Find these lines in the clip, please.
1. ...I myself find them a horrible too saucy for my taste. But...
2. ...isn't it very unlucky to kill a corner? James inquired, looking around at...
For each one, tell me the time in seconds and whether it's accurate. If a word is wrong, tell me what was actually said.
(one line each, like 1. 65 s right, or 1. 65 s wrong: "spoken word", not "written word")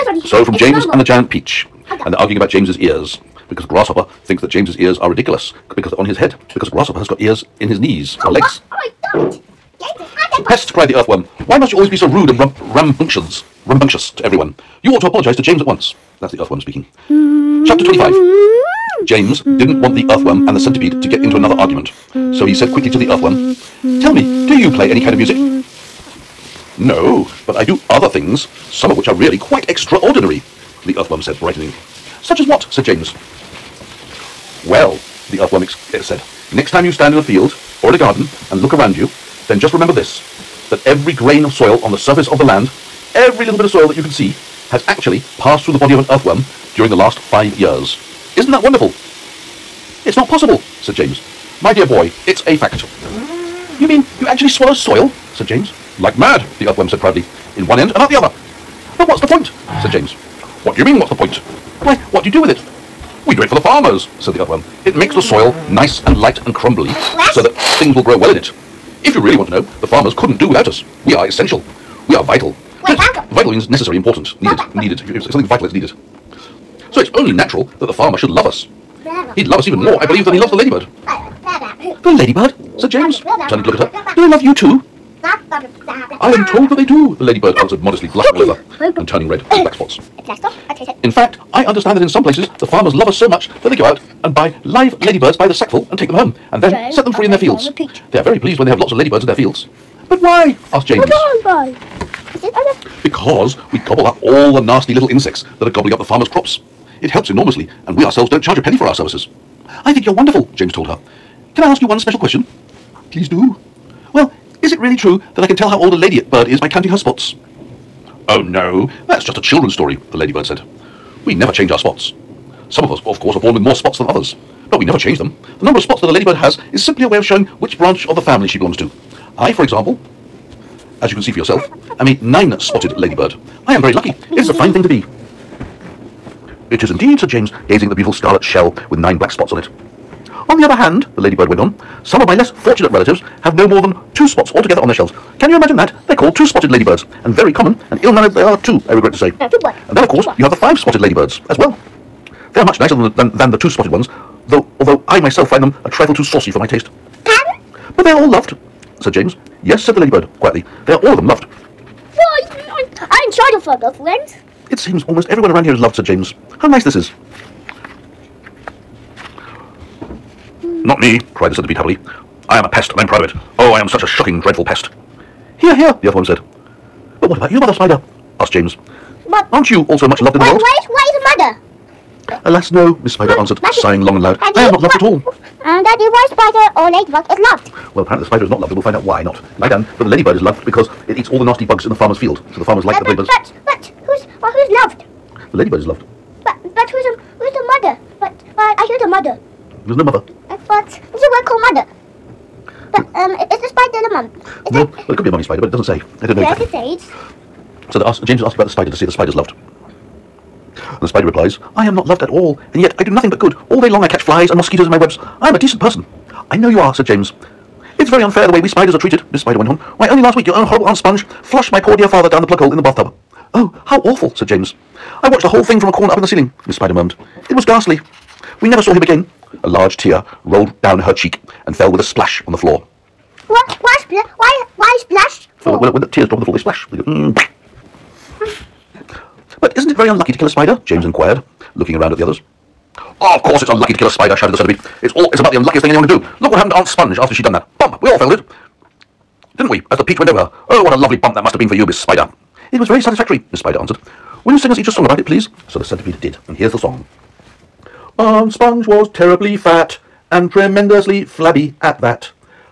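1. 155 s wrong: "trifle", not "horrible"
2. 239 s wrong: "spider", not "corner".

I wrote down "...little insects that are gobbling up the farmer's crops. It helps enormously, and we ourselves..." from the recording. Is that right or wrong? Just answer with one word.
right.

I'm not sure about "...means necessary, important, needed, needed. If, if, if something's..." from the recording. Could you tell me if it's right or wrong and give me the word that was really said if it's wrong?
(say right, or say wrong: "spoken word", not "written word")
right.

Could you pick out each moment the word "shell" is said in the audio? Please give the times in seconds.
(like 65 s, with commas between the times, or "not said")
138 s, 144 s.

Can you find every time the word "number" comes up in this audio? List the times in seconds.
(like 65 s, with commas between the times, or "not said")
125 s.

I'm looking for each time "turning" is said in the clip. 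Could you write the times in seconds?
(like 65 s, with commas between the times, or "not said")
83 s, 89 s.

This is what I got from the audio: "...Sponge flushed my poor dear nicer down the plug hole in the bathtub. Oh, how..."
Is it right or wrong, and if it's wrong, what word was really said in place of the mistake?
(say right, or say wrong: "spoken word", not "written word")
wrong: "father", not "nicer".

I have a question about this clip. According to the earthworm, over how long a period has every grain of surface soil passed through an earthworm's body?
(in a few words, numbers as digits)
5 years.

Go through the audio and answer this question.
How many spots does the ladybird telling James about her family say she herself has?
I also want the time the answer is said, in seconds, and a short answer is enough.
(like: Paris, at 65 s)
9, at 132 s.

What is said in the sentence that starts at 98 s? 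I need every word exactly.
They are very pleased when they have lots of ladybirds in their fields.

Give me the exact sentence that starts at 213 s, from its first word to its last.
All day long I catch flies and mosquitoes in my webs.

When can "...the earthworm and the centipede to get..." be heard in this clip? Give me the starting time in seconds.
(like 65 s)
19 s.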